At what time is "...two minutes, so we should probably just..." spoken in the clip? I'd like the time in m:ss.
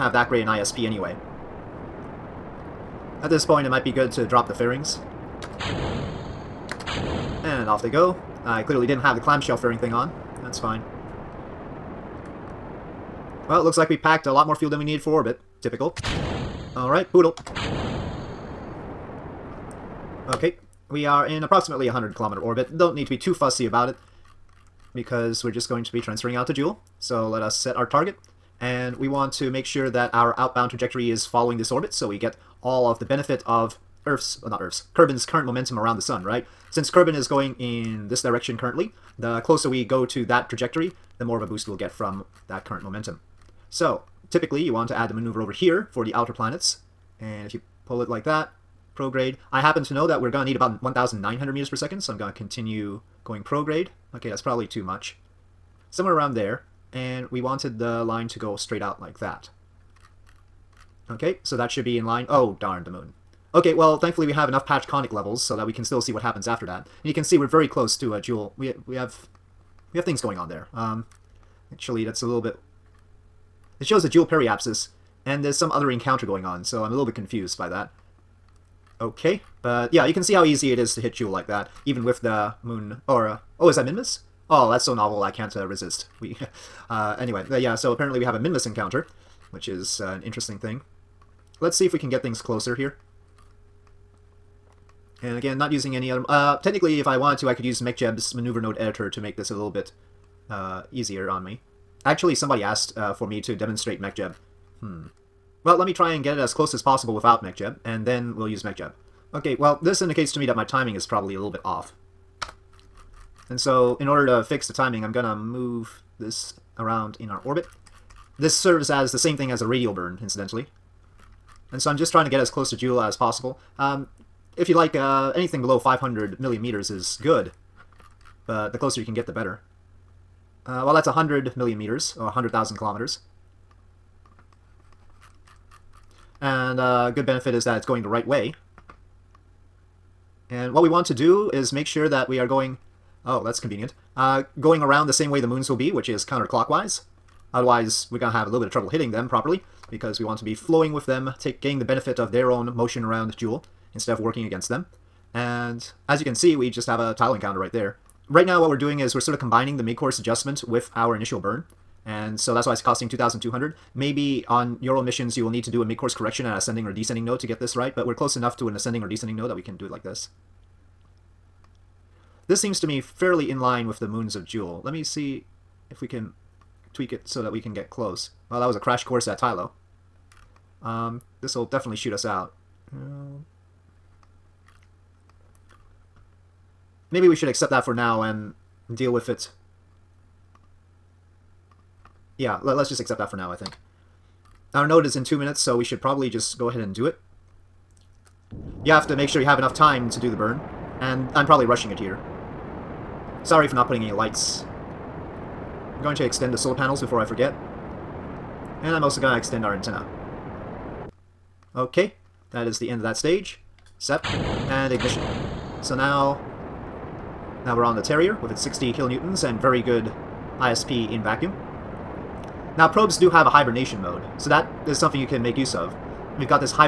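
3:15.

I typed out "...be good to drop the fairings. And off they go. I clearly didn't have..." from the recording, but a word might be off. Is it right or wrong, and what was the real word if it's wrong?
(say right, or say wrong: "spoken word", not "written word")
right.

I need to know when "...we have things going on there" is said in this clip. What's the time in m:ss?
1:09.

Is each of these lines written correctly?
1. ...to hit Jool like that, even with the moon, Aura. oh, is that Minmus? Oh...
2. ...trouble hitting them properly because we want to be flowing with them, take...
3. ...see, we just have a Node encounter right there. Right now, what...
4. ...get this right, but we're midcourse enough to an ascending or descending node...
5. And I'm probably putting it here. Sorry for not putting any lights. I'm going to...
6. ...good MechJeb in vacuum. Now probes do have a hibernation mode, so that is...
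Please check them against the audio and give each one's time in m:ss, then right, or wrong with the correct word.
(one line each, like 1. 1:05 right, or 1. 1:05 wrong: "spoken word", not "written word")
1. 1:20 right
2. 2:28 right
3. 2:36 wrong: "Tylo", not "Node"
4. 2:47 wrong: "close", not "midcourse"
5. 3:20 wrong: "rushing", not "putting"
6. 3:39 wrong: "ISP", not "MechJeb".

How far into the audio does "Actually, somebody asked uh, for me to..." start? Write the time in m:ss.
1:42.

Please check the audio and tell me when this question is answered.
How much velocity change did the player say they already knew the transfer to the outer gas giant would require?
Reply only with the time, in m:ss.
0:50.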